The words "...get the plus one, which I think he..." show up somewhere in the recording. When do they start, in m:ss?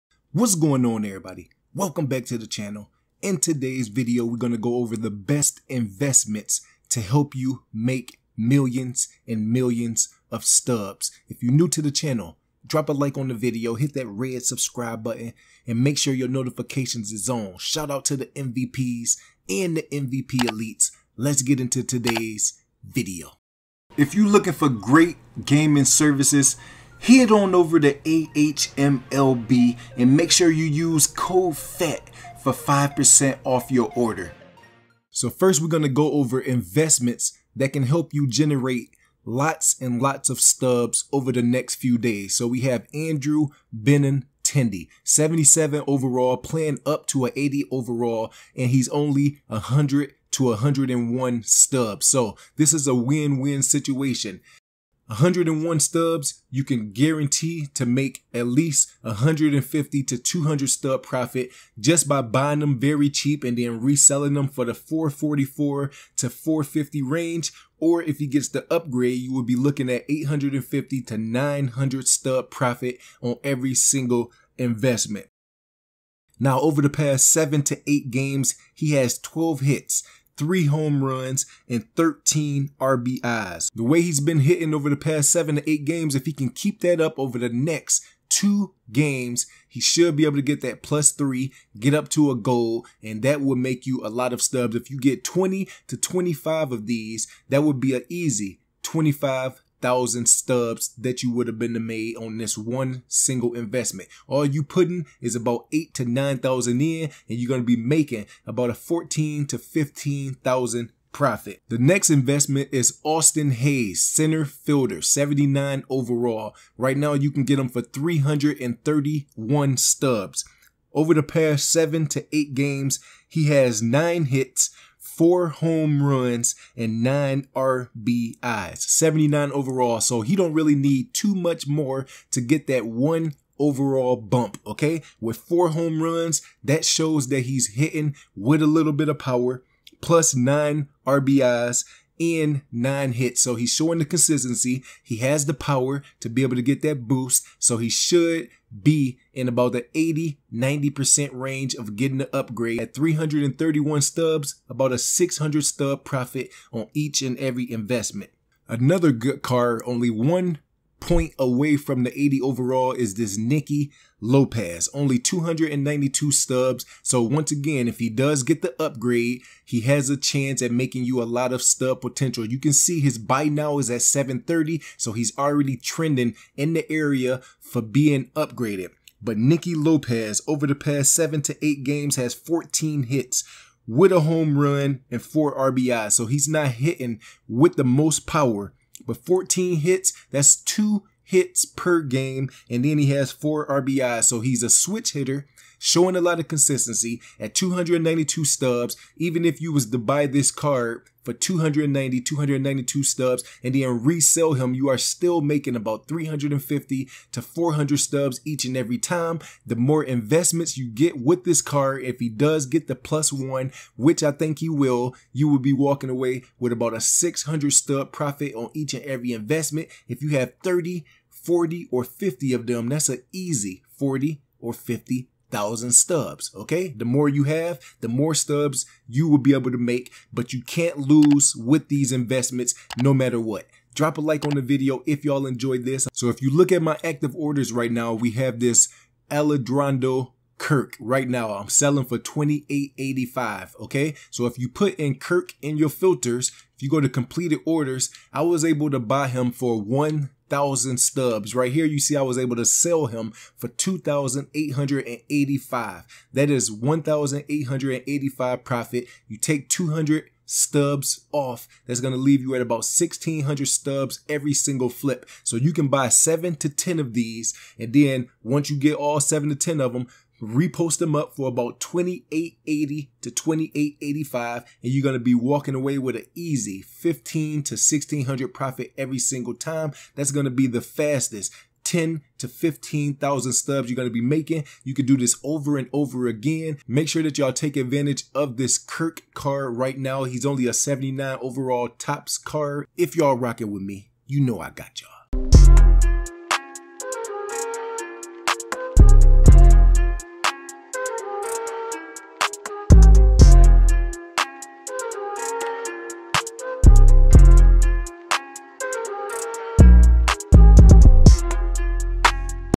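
3:32.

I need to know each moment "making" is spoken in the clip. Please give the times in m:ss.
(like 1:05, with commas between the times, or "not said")
1:47, 2:50, 3:25, 4:44.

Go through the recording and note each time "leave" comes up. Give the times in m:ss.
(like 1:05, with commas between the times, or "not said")
4:22.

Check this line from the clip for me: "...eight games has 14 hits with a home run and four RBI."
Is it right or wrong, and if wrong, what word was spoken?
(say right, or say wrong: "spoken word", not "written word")
right.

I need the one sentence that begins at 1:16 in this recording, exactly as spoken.
Now, over the past seven to eight games, he has 12 hits, three home runs, and 13 RBIs.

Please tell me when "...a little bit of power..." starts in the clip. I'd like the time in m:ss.
2:18.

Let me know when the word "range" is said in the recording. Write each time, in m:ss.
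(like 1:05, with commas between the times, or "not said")
1:07, 2:31.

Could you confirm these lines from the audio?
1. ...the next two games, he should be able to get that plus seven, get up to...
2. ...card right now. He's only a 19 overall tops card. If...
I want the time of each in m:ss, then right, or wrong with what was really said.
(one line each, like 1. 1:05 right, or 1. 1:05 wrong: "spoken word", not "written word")
1. 1:27 wrong: "three", not "seven"
2. 4:49 wrong: "79", not "19".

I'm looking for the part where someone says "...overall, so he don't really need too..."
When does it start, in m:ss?
2:09.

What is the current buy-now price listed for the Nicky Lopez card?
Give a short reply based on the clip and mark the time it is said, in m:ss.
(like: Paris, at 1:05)
730, at 2:54.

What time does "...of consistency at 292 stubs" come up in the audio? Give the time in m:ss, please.
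3:16.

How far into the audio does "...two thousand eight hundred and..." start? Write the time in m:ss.
4:13.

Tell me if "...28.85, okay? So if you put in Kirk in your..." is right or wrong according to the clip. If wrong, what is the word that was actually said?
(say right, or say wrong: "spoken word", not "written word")
right.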